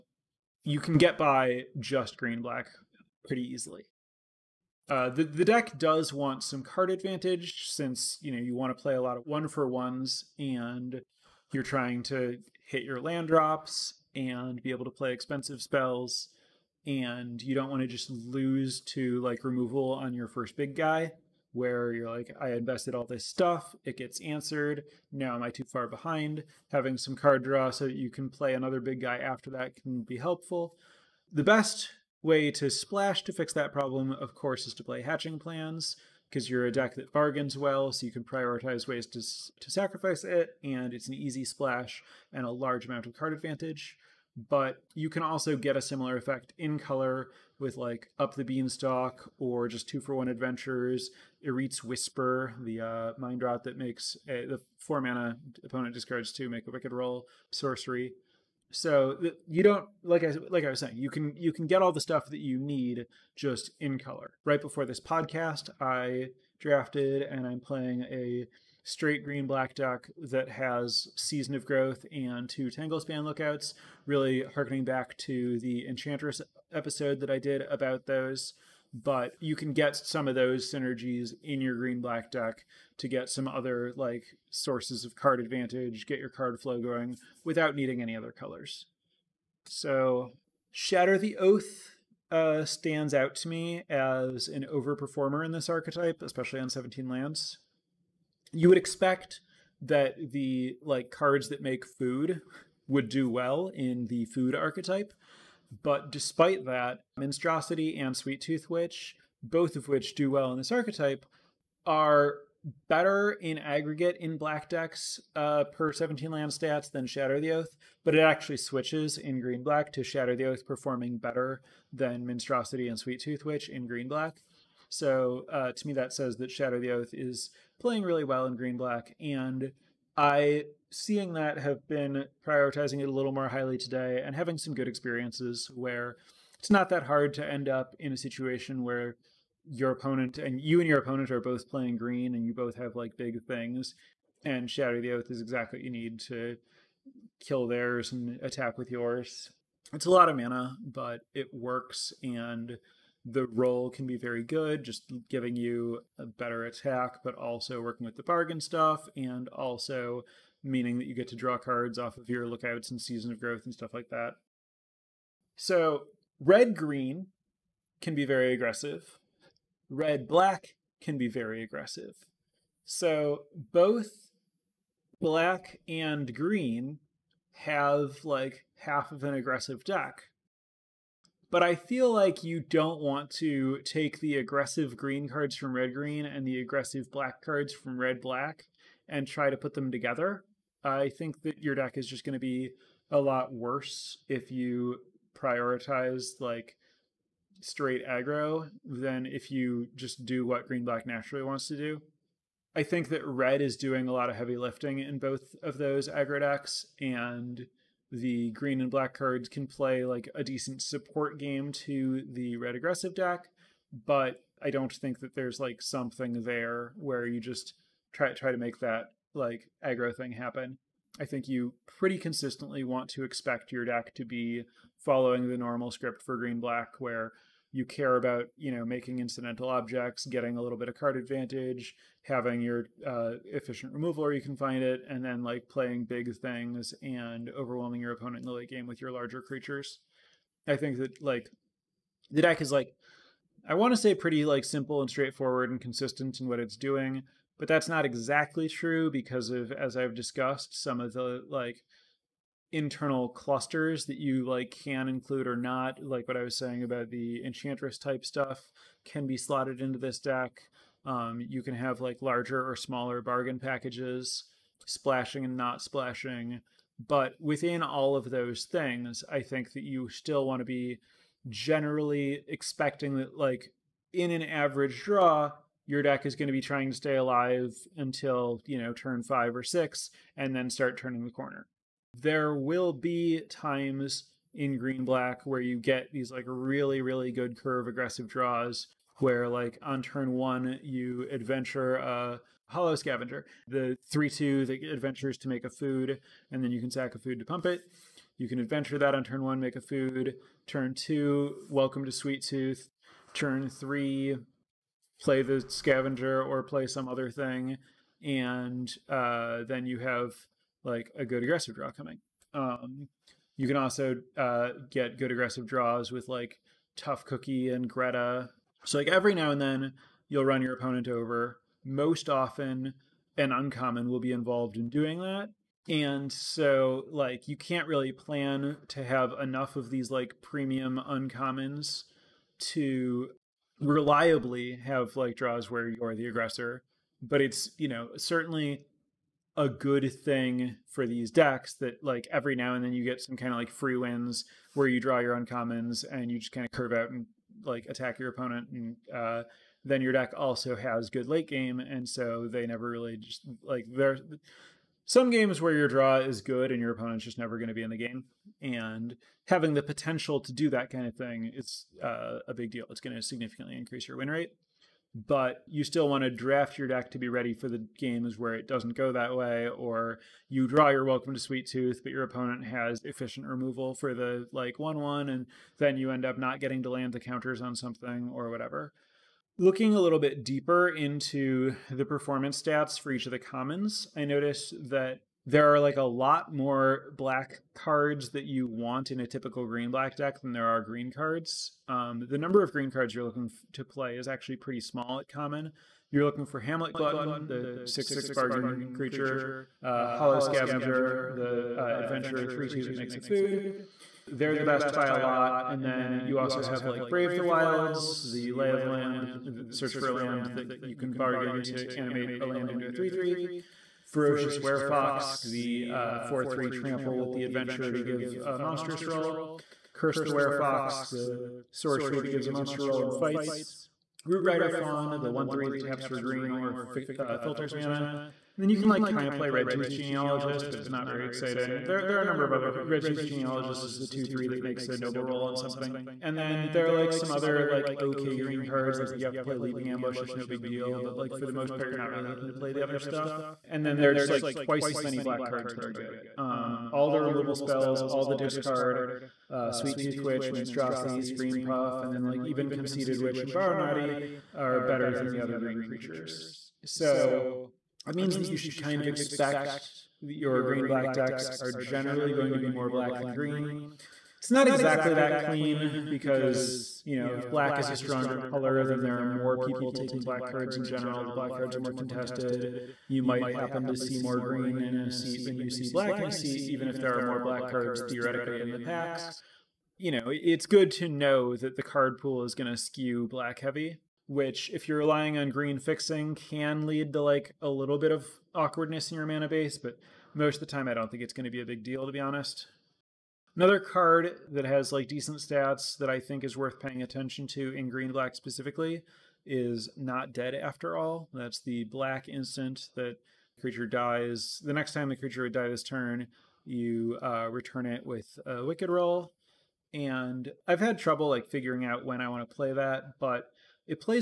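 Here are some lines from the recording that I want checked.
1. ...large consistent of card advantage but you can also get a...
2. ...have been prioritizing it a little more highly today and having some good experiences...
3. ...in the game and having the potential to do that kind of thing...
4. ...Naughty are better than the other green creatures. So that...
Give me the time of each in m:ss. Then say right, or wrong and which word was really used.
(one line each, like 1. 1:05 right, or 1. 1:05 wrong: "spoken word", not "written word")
1. 0:42 wrong: "amount", not "consistent"
2. 2:11 right
3. 5:57 right
4. 7:33 right.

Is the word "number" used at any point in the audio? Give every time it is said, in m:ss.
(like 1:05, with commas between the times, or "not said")
6:32, 7:12.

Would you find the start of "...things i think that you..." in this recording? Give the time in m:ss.
4:28.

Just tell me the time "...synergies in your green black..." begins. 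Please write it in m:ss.
1:20.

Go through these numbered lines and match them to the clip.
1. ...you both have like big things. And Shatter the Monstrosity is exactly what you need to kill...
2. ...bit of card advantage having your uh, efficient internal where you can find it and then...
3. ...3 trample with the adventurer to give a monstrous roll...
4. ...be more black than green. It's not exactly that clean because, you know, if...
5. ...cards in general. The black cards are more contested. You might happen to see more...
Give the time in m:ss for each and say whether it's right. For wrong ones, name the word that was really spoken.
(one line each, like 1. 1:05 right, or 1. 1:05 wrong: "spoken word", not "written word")
1. 2:22 wrong: "Oath", not "Monstrosity"
2. 3:50 wrong: "removal", not "internal"
3. 6:56 right
4. 7:42 right
5. 7:50 right.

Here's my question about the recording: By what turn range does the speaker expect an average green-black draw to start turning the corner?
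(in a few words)
five or six.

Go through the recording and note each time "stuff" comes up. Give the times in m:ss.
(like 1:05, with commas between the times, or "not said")
0:23, 1:02, 2:38, 2:43, 4:18, 7:22.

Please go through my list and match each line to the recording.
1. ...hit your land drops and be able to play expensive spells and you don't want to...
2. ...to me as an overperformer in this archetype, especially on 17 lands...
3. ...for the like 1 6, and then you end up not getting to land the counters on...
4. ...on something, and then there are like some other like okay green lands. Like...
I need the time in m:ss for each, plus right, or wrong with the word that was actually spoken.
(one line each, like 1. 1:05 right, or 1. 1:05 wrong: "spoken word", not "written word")
1. 0:12 right
2. 1:33 right
3. 6:13 wrong: "1", not "6"
4. 7:15 wrong: "cards", not "lands".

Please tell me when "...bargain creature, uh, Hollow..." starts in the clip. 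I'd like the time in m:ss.
6:38.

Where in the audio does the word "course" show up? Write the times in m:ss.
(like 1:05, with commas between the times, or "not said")
0:34.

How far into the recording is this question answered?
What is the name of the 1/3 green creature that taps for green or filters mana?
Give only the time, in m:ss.
7:04.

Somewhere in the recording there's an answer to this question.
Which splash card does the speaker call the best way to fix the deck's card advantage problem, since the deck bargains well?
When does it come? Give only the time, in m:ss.
0:35.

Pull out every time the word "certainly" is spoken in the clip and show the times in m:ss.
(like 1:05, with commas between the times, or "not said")
5:38.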